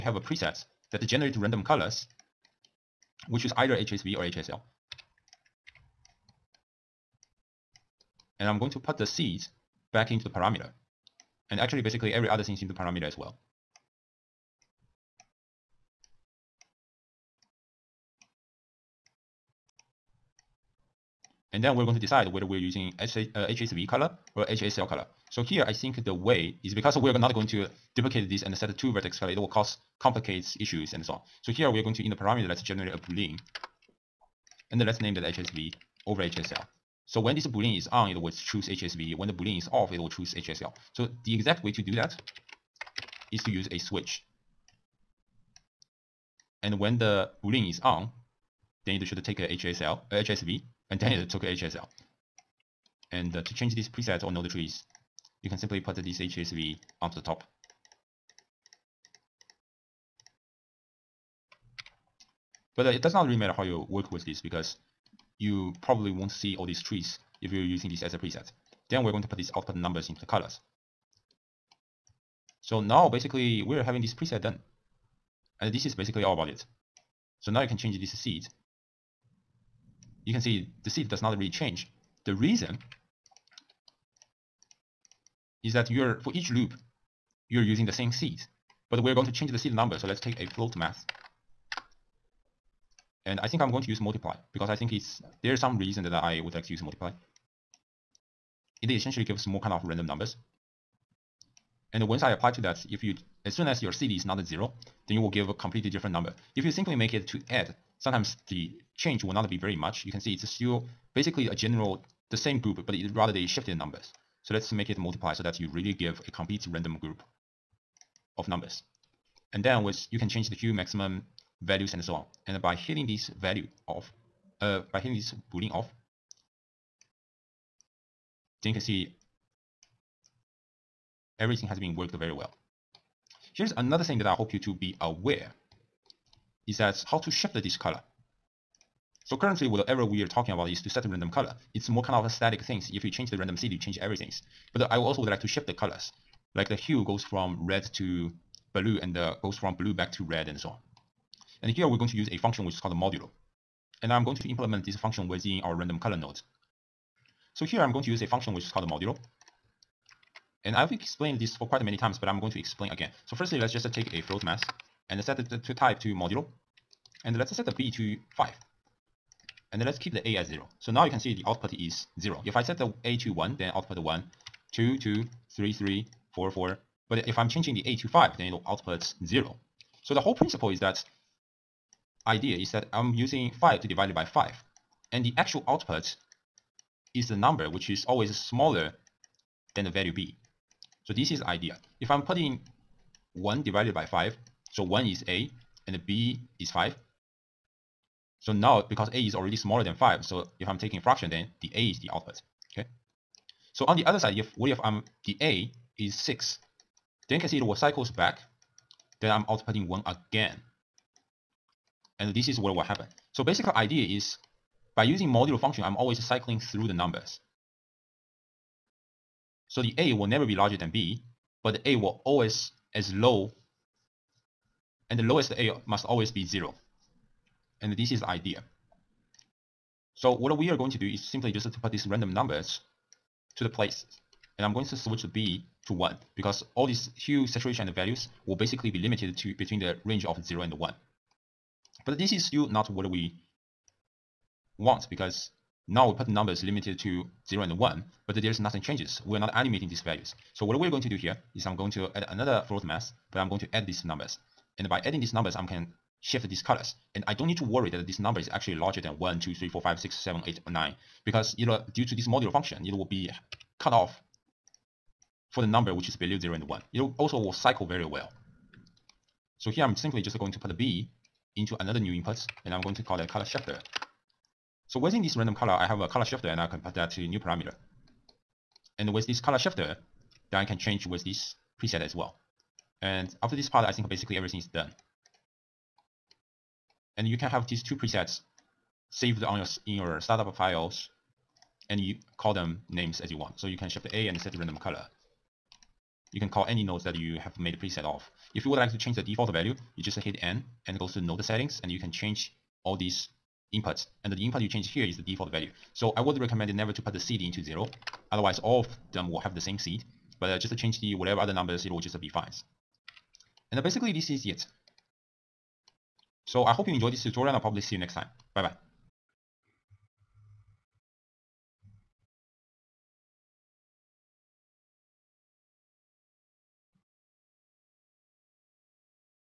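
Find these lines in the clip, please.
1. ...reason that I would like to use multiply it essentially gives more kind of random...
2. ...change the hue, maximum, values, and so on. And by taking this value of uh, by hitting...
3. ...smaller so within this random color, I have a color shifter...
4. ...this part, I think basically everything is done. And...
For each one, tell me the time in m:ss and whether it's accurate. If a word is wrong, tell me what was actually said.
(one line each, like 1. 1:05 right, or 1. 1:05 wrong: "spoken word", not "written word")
1. 1:35 right
2. 2:00 wrong: "hitting", not "taking"
3. 4:33 wrong: "shifter", not "smaller"
4. 4:43 right.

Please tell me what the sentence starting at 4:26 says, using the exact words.
It will also will cycle very well.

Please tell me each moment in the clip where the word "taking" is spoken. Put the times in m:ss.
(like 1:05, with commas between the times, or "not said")
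3:20.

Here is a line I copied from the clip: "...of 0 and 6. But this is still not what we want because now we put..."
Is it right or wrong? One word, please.
wrong.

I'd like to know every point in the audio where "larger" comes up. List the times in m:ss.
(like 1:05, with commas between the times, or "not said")
3:40, 4:18.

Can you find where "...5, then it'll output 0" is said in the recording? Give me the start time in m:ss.
2:58.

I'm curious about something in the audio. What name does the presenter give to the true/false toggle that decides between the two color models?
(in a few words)
HSV over HSL.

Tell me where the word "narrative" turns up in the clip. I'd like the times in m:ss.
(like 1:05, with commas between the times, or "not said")
not said.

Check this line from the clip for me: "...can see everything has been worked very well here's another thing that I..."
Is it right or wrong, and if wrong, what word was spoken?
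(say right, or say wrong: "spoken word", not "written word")
right.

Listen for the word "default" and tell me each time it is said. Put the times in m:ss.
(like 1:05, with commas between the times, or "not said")
4:59, 5:05.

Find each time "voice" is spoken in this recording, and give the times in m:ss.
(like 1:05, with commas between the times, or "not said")
not said.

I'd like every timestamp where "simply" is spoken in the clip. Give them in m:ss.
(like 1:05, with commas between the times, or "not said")
0:55, 1:46, 3:51, 4:29.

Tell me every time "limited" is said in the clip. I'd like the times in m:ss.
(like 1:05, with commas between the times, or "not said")
3:58, 4:06.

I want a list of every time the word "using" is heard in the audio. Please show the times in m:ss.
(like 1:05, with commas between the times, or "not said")
0:22, 1:07, 1:27, 3:03, 3:35.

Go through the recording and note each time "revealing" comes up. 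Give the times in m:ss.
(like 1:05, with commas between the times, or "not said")
not said.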